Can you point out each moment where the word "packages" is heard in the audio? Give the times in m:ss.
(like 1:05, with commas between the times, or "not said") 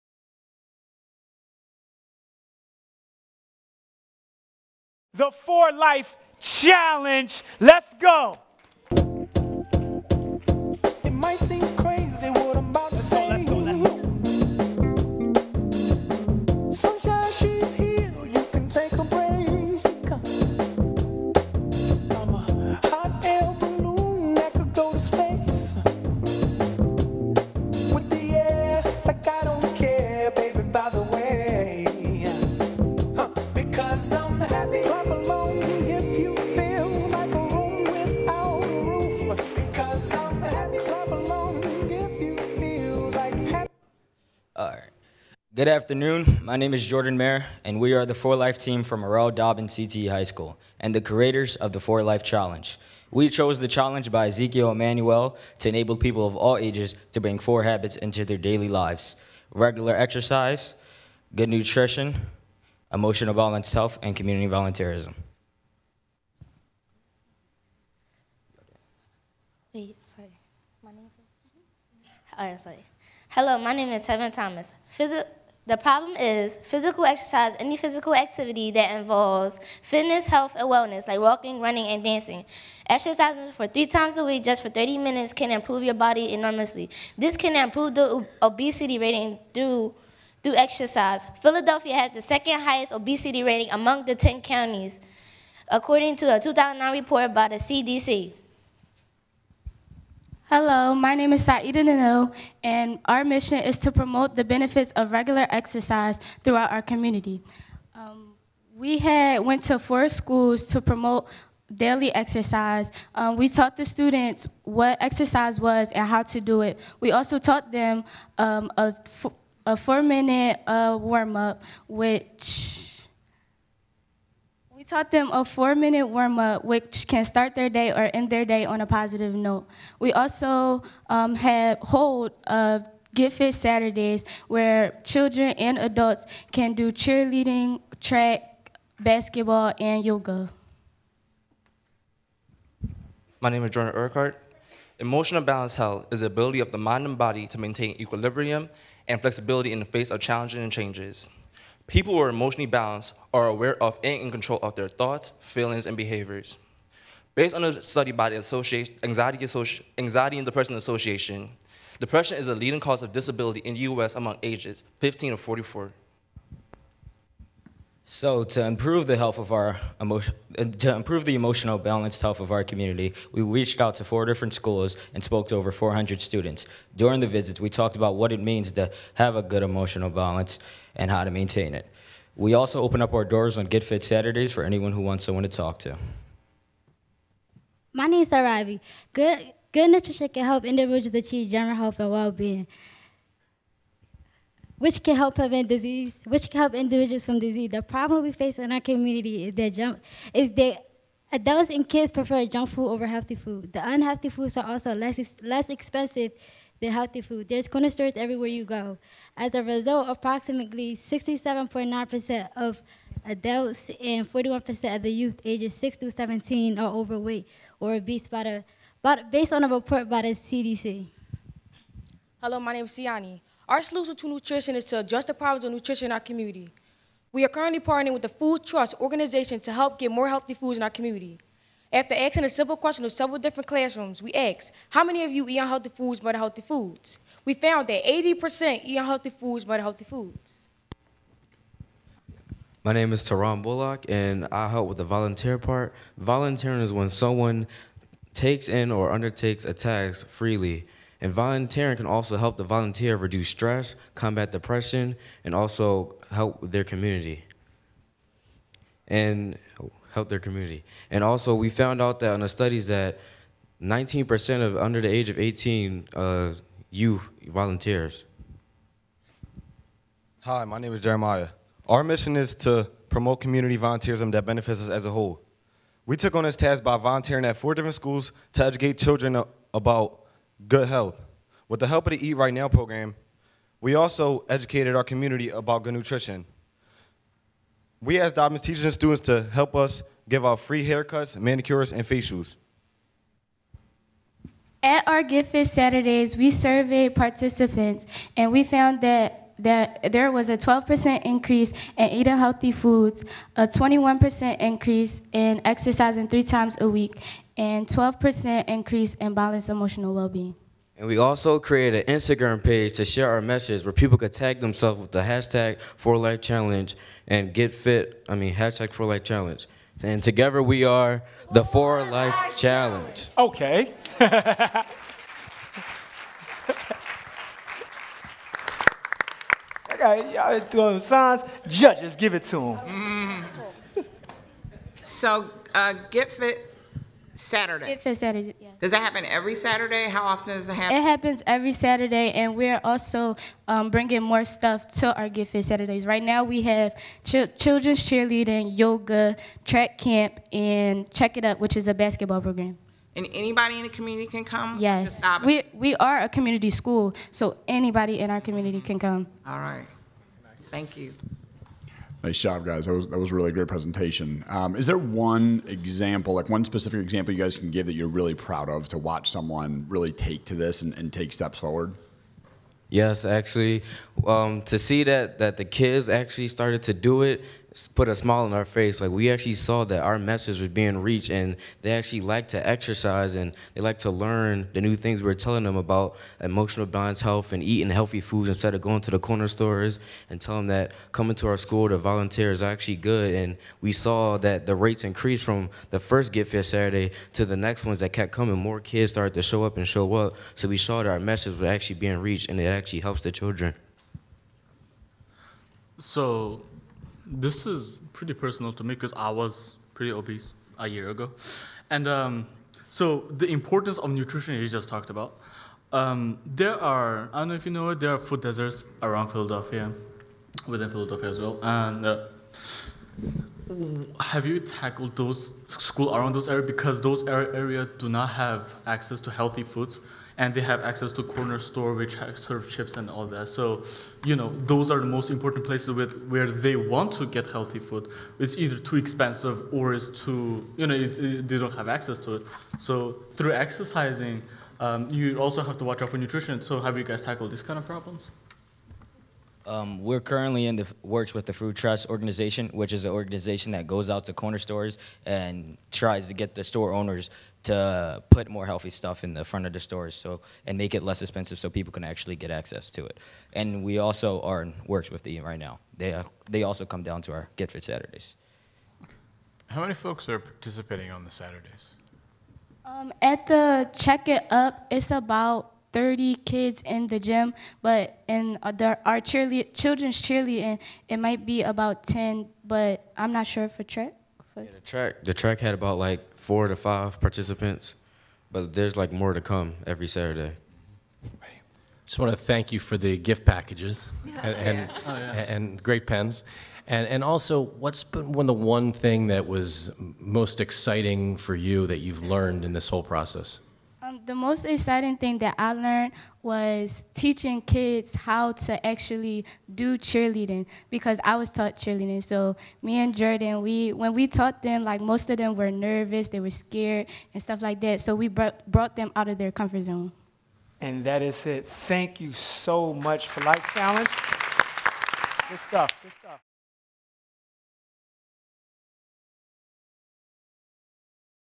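8:13.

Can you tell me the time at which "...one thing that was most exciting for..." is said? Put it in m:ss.
8:18.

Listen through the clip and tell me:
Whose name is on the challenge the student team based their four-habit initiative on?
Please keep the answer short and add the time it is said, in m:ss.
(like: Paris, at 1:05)
Ezekiel Emanuel, at 0:54.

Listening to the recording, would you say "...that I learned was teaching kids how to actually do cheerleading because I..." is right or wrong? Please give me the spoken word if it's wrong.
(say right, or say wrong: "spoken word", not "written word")
right.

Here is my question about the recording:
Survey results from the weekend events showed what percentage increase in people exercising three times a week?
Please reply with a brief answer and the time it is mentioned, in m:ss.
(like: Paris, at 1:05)
21%, at 5:03.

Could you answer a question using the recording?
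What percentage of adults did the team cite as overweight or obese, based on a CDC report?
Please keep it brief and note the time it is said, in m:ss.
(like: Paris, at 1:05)
67.9%, at 3:30.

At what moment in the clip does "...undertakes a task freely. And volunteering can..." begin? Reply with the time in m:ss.
4:09.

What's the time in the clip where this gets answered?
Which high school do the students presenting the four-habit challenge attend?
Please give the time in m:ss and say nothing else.
0:49.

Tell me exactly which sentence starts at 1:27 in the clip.
This can improve the obesity rating through through exercise.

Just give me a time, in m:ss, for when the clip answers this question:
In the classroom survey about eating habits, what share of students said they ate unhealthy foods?
3:58.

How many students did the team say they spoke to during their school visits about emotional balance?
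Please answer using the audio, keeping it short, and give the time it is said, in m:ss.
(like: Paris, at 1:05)
over 400, at 2:55.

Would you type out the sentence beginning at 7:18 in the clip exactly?
It's either too expensive or it's too, you know, it, it, they don't have access to it.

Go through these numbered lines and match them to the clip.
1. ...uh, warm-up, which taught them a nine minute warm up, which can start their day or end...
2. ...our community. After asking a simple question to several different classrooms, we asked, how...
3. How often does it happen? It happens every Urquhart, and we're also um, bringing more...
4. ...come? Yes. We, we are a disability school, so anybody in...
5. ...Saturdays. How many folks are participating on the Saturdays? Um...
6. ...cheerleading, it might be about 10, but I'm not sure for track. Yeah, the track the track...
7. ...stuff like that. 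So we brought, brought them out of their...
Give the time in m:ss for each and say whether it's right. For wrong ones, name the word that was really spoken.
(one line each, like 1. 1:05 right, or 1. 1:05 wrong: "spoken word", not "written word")
1. 2:00 wrong: "four", not "nine"
2. 3:50 right
3. 5:40 wrong: "Saturday", not "Urquhart"
4. 5:54 wrong: "community", not "disability"
5. 7:47 right
6. 8:00 right
7. 8:37 right.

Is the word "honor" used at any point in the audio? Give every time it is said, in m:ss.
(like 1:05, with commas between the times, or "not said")
not said.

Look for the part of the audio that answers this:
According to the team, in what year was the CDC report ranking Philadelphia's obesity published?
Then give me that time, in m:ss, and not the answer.
1:36.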